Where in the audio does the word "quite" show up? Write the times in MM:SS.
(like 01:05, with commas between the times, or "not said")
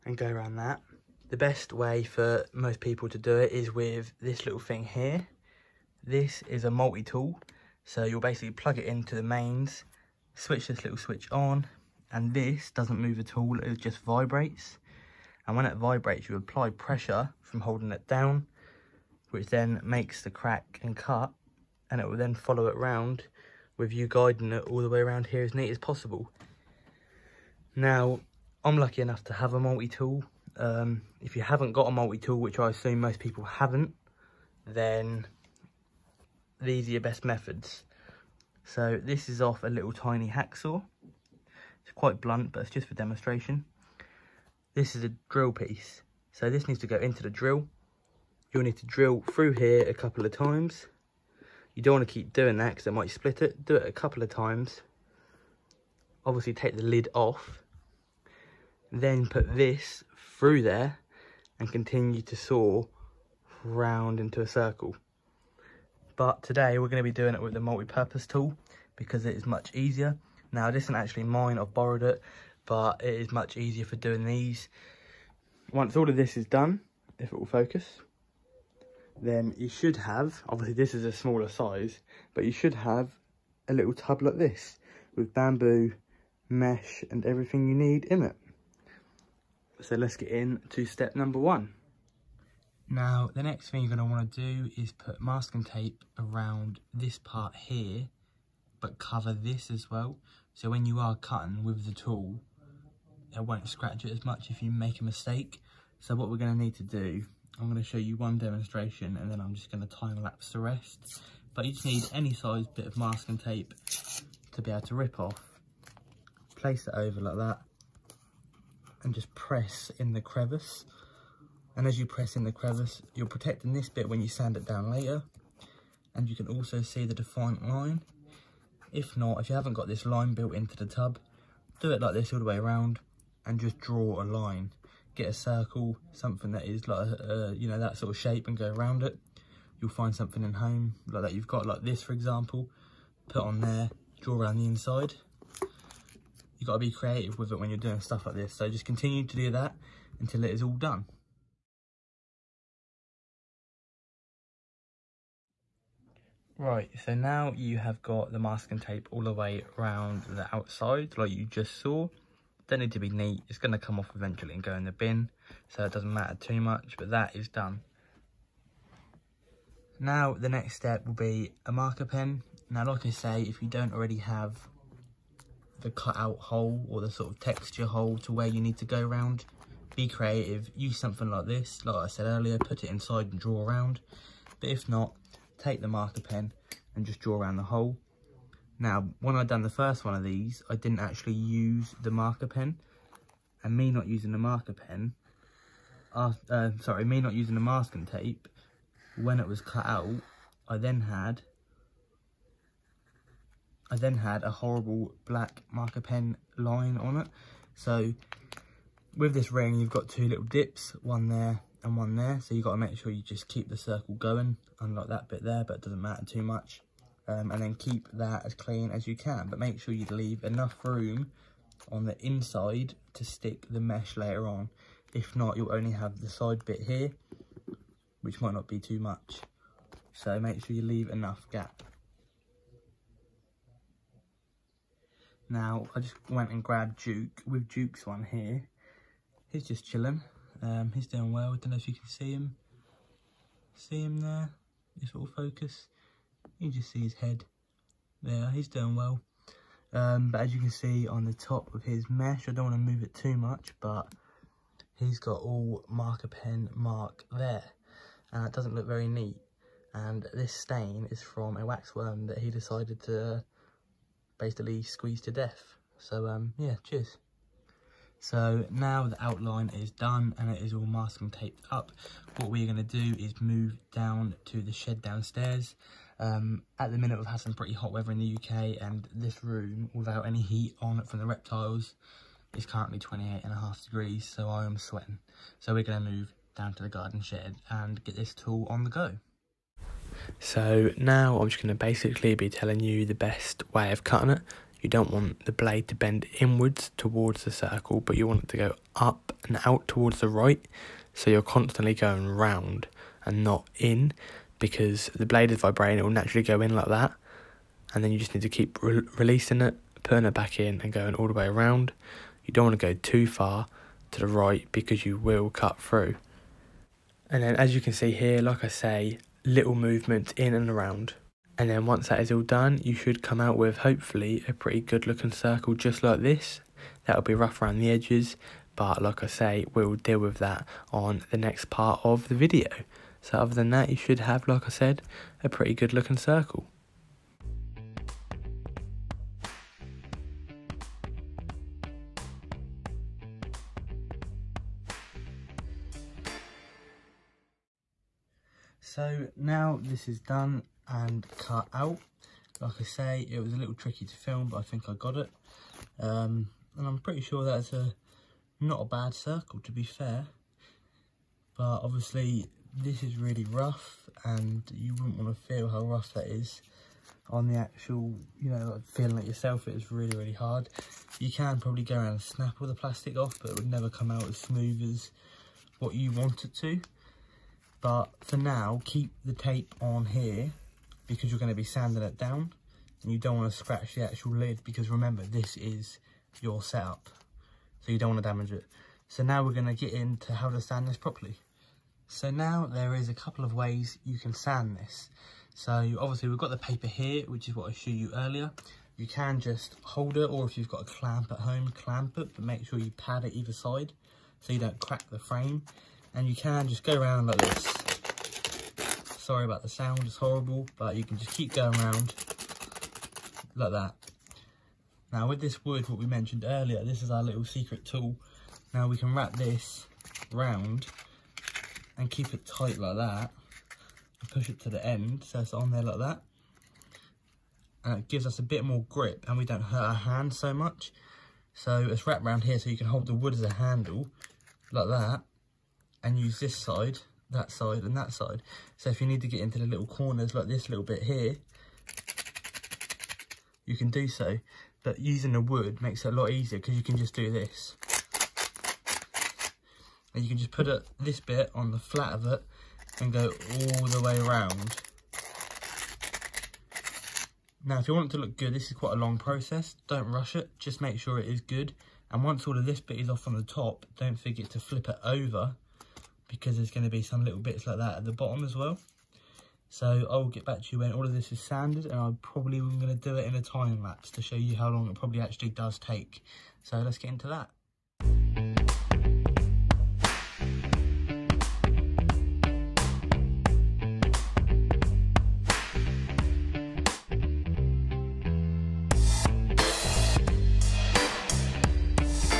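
00:41, 07:38.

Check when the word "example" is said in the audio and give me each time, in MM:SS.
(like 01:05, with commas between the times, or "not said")
02:22.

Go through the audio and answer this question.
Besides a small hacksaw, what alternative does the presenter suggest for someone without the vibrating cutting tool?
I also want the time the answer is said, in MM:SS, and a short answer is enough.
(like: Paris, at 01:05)
drill piece, at 00:45.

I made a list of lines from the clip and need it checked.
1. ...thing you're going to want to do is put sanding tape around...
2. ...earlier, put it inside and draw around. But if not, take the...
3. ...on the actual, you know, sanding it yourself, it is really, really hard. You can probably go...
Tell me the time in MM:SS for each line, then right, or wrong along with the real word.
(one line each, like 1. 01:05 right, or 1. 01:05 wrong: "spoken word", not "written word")
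1. 01:33 wrong: "masking", not "sanding"
2. 03:02 right
3. 06:07 wrong: "feeling", not "sanding".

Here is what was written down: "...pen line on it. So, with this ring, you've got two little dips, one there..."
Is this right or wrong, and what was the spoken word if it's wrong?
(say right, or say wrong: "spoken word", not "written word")
right.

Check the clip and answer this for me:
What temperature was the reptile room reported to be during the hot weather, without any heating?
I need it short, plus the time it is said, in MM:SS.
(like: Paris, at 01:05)
28.5 degrees, at 04:42.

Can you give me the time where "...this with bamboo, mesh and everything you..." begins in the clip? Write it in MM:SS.
01:24.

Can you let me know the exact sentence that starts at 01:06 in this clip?
But today we're going to be doing it with the multi-purpose tool because it is much easier.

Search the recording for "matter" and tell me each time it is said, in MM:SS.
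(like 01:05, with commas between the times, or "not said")
02:46, 03:36.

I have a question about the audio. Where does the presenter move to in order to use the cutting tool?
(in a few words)
garden shed.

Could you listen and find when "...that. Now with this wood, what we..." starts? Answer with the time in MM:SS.
06:53.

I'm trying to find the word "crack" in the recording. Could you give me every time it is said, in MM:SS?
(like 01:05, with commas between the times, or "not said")
00:20, 06:44.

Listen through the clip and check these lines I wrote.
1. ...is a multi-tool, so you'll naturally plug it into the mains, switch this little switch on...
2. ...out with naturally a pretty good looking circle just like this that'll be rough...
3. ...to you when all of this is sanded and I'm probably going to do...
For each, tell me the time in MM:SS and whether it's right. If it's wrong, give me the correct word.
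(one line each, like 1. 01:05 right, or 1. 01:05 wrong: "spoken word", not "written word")
1. 00:06 wrong: "basically", not "naturally"
2. 05:23 wrong: "hopefully", not "naturally"
3. 07:50 right.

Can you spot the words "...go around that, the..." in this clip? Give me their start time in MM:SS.
00:00.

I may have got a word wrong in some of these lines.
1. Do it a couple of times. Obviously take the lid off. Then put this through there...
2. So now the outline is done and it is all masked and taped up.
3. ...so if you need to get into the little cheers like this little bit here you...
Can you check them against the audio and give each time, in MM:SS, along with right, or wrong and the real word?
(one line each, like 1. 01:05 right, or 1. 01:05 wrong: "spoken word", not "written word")
1. 00:53 right
2. 04:28 right
3. 07:18 wrong: "corners", not "cheers".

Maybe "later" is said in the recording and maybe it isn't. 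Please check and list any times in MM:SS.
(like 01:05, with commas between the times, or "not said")
02:04, 03:44.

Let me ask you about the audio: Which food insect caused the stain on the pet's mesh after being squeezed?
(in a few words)
wax worm.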